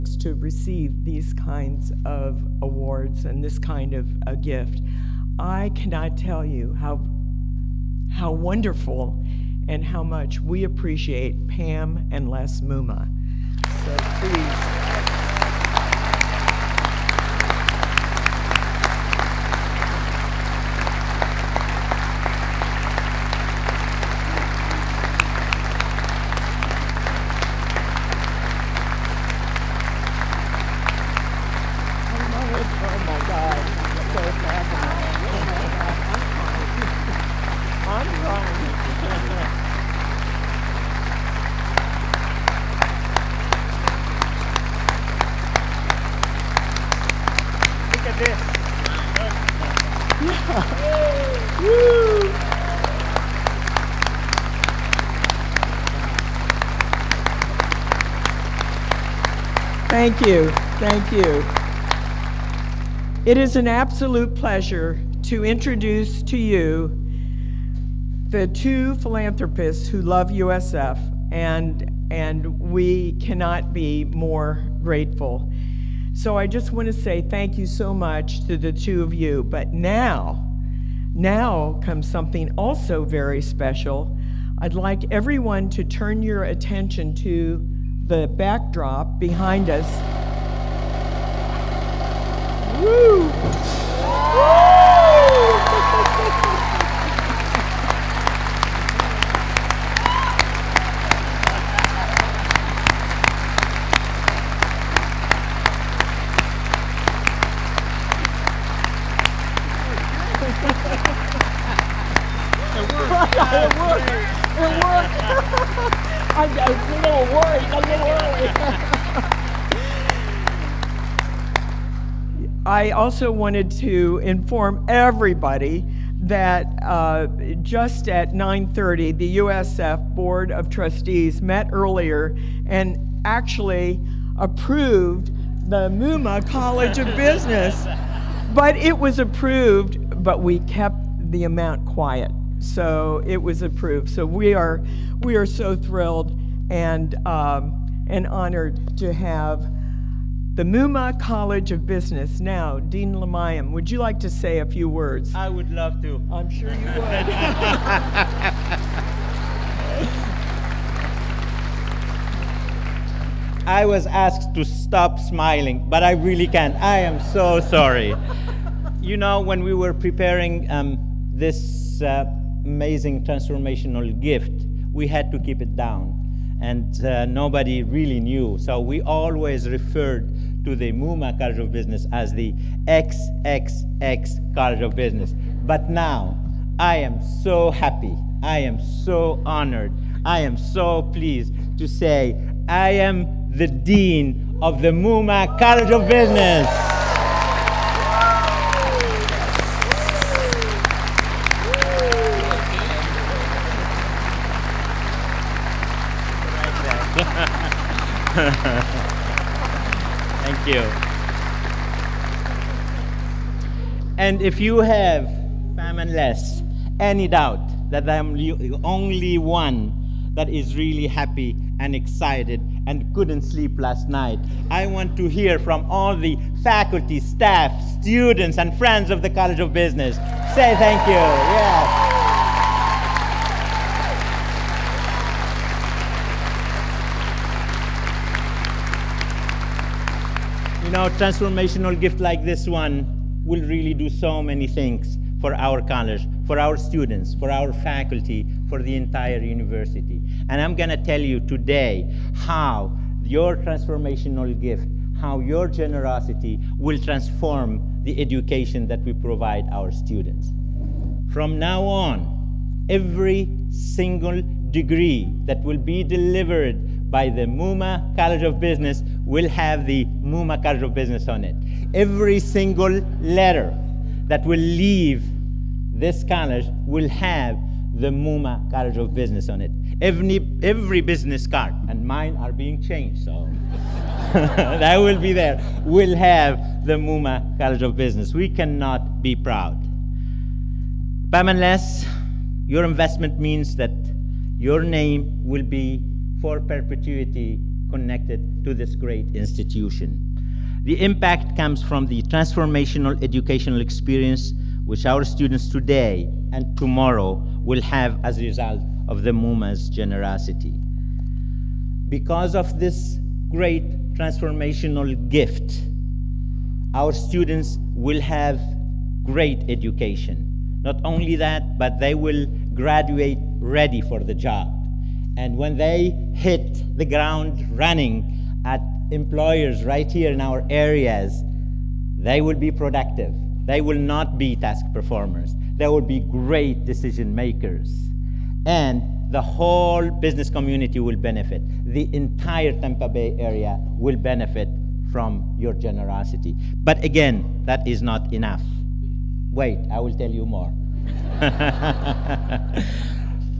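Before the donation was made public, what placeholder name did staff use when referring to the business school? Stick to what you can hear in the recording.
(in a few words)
XXX College of Business.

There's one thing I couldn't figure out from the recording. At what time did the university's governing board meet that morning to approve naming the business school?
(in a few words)
9:30.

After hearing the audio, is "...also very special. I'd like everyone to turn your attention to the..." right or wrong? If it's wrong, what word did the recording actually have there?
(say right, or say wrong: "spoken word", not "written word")
right.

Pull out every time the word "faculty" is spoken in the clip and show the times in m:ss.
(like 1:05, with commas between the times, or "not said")
3:46, 4:07.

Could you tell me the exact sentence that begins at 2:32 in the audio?
Now, Dean Limayem, would you like to say a few words?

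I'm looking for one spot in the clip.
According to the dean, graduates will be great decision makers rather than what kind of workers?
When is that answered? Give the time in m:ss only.
5:34.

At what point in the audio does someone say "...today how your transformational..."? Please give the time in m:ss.
4:11.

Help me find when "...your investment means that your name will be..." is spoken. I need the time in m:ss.
4:52.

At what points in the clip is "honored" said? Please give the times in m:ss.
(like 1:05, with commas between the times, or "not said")
2:28, 3:09.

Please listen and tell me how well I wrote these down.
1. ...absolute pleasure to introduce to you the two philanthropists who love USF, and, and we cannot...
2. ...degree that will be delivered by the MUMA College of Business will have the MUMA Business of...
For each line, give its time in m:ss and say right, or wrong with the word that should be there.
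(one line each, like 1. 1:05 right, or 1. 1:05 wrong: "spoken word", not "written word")
1. 1:03 right
2. 4:24 wrong: "College", not "Business".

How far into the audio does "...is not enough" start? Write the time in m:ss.
5:47.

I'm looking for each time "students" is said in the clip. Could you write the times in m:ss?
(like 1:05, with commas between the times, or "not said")
3:48, 4:06, 4:19, 5:05, 5:17.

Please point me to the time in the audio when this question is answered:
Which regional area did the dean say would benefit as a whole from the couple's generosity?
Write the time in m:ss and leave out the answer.
5:42.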